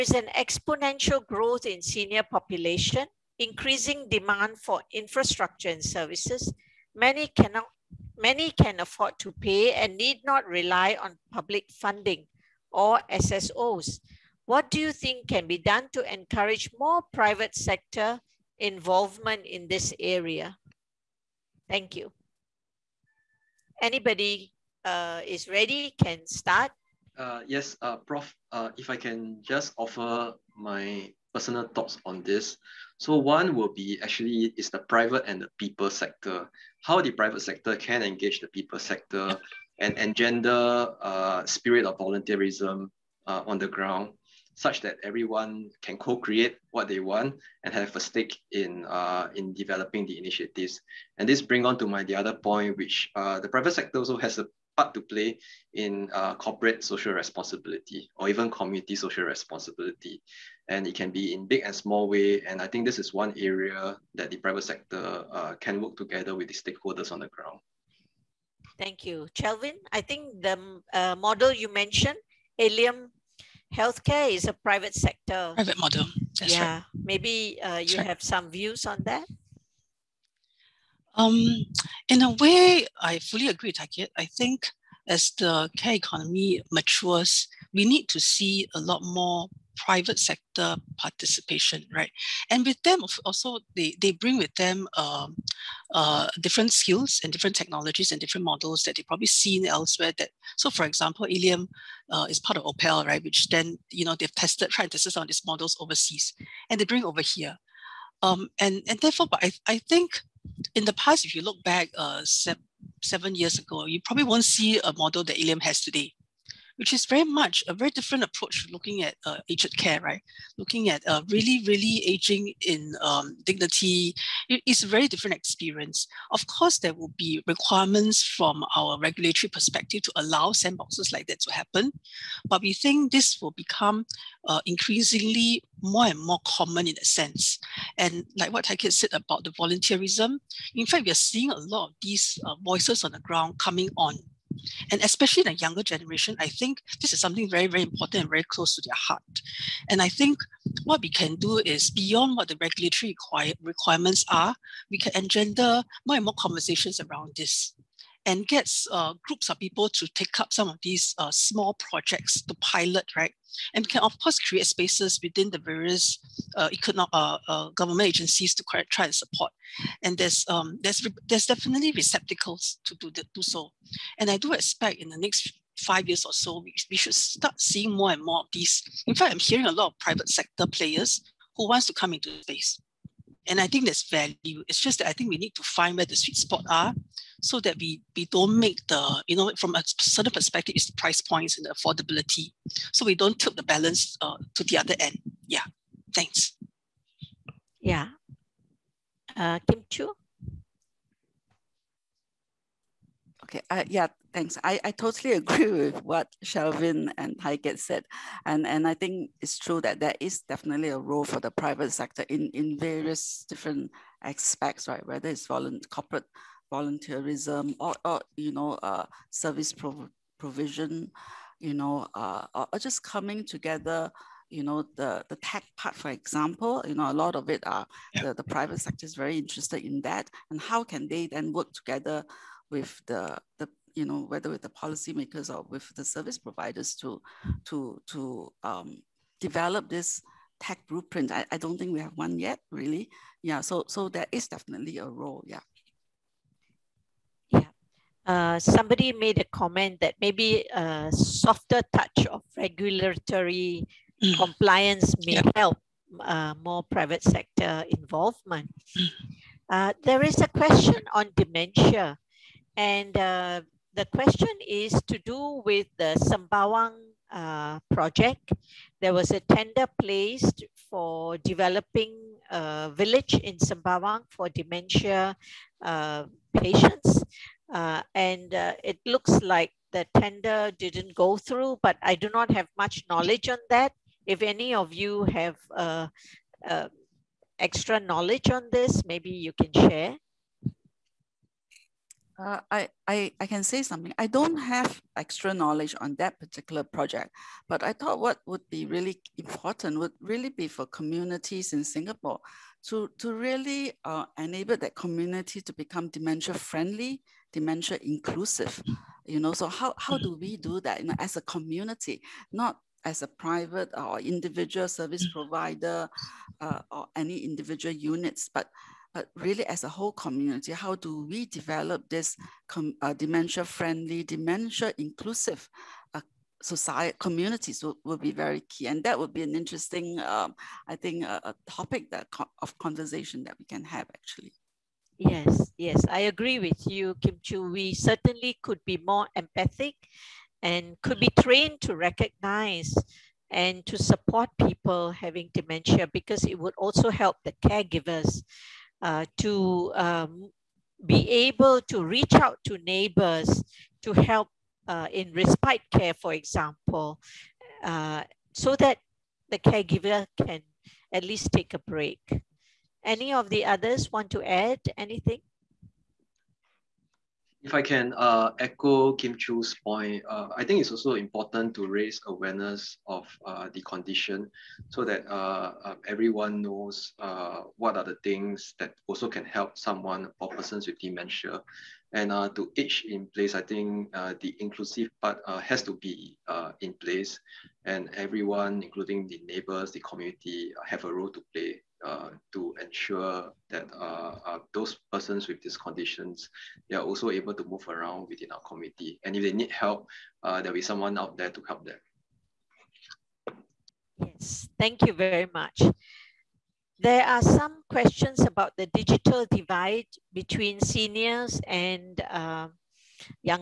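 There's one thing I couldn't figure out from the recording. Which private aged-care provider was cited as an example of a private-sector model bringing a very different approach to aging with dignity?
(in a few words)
Allium Healthcare.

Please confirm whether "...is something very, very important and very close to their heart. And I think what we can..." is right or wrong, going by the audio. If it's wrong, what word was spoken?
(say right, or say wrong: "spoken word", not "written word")
right.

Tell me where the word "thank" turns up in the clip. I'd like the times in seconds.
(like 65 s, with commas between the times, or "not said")
21 s, 68 s, 196 s, 204 s, 404 s.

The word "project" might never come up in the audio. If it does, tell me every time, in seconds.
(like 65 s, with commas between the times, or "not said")
161 s, 267 s, 296 s.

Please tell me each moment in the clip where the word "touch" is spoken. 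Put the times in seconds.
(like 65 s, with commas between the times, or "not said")
251 s.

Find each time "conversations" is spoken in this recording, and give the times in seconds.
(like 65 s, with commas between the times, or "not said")
156 s, 332 s.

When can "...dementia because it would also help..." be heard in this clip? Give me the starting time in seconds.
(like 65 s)
345 s.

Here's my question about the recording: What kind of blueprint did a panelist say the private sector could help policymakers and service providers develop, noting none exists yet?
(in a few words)
tech blueprint.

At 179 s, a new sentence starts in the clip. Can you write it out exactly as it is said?
In fact, I'm hearing a lot of private sector players who wants to come into space.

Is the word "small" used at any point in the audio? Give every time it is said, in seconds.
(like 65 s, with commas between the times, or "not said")
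61 s, 161 s.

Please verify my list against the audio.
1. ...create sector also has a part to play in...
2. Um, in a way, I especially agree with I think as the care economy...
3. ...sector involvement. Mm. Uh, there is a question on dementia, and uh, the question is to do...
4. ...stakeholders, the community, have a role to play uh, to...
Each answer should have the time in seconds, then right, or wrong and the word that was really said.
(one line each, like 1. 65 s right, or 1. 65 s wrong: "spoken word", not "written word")
1. 53 s wrong: "private", not "create"
2. 81 s wrong: "fully", not "especially"
3. 257 s right
4. 389 s wrong: "neighbors", not "stakeholders".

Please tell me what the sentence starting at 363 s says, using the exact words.
Any of the others want to add anything?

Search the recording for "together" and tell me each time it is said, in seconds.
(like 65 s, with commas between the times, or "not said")
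65 s, 223 s, 231 s.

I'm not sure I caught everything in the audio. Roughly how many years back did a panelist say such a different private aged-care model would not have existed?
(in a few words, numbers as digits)
7.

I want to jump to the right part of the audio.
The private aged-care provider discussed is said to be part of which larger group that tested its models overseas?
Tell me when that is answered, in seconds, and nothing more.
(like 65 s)
102 s.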